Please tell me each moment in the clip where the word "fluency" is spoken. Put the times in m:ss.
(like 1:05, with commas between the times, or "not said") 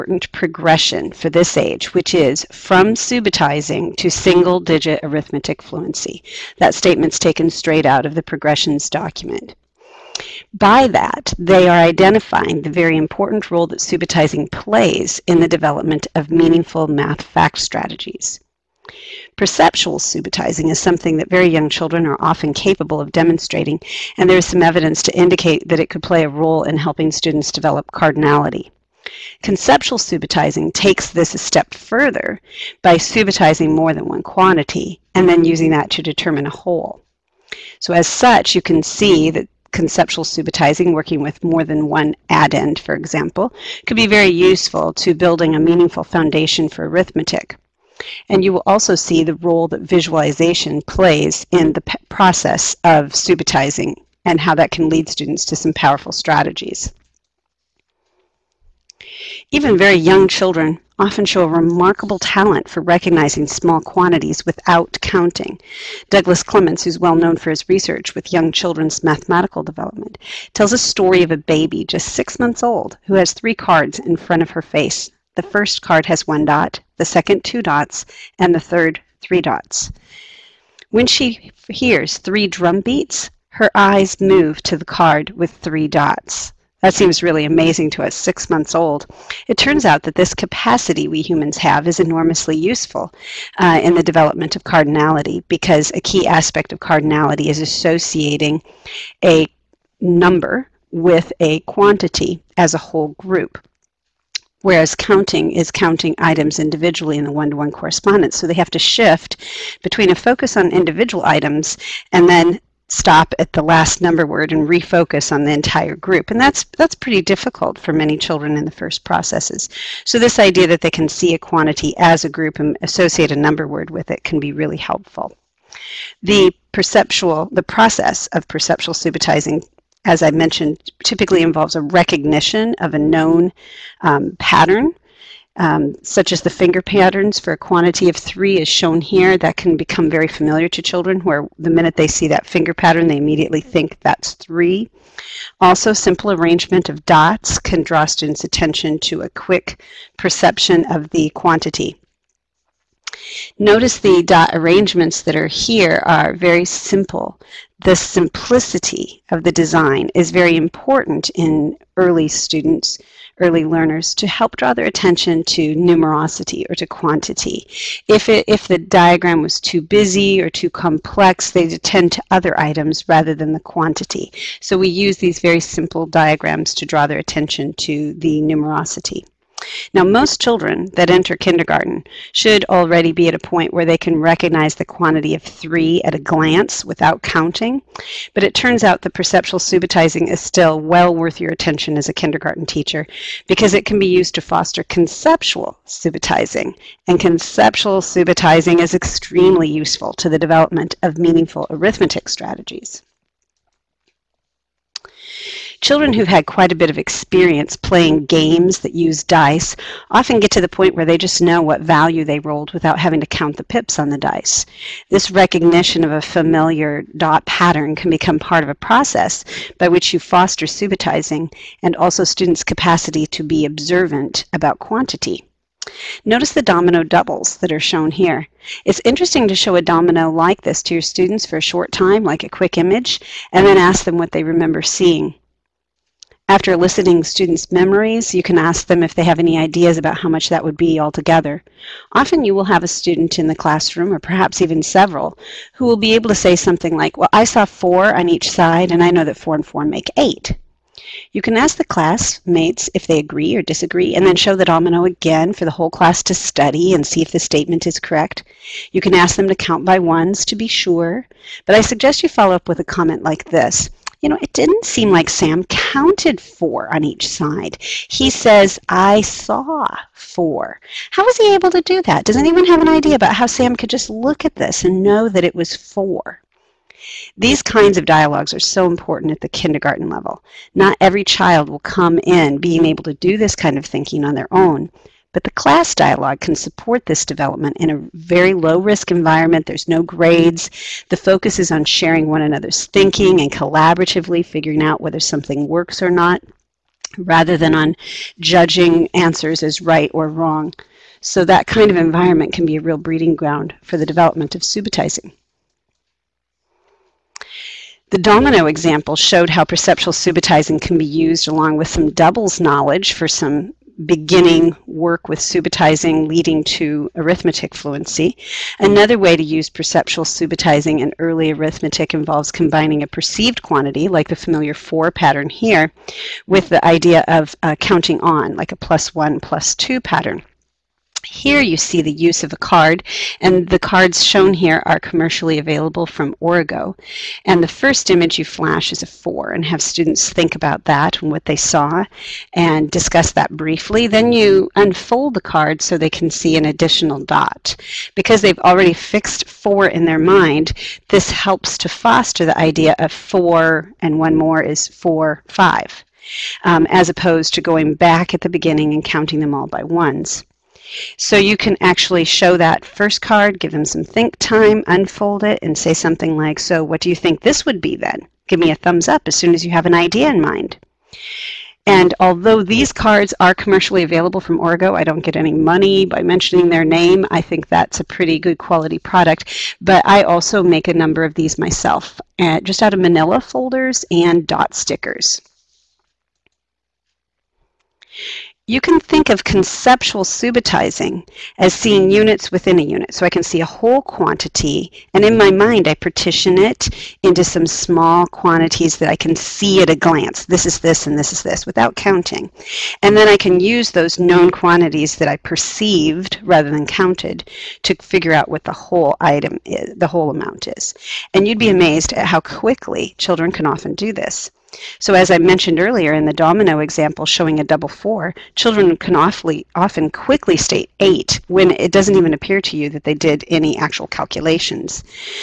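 0:05, 5:17.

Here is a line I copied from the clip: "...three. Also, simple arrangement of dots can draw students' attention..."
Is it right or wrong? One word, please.
right.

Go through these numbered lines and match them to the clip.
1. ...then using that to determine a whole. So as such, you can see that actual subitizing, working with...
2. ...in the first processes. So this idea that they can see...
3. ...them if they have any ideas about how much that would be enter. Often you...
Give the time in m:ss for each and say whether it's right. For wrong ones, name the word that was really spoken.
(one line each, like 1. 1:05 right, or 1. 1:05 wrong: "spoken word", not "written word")
1. 0:35 wrong: "conceptual", not "actual"
2. 1:58 right
3. 3:58 wrong: "altogether", not "enter".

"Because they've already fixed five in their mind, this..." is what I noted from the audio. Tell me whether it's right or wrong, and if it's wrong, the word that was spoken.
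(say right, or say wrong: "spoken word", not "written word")
wrong: "four", not "five".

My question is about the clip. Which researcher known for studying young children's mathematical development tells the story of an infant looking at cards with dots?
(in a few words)
Douglas Clements.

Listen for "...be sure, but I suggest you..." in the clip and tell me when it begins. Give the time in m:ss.
4:20.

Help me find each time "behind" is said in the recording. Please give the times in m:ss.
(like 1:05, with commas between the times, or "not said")
not said.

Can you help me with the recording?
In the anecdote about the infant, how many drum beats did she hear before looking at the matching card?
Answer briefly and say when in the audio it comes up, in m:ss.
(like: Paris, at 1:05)
3, at 1:22.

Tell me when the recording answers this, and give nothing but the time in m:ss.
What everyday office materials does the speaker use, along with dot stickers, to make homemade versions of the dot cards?
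6:22.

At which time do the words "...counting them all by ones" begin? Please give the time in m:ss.
5:59.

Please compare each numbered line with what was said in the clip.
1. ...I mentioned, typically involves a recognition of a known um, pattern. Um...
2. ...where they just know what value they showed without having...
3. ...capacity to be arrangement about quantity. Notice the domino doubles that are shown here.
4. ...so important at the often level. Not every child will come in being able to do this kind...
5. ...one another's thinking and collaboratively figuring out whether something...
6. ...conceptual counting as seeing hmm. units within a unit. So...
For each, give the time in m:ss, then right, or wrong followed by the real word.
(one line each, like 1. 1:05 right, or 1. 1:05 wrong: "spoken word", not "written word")
1. 2:10 right
2. 3:30 wrong: "rolled", not "showed"
3. 3:42 wrong: "observant", not "arrangement"
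4. 4:38 wrong: "kindergarten", not "often"
5. 4:52 right
6. 6:29 wrong: "subitizing", not "counting".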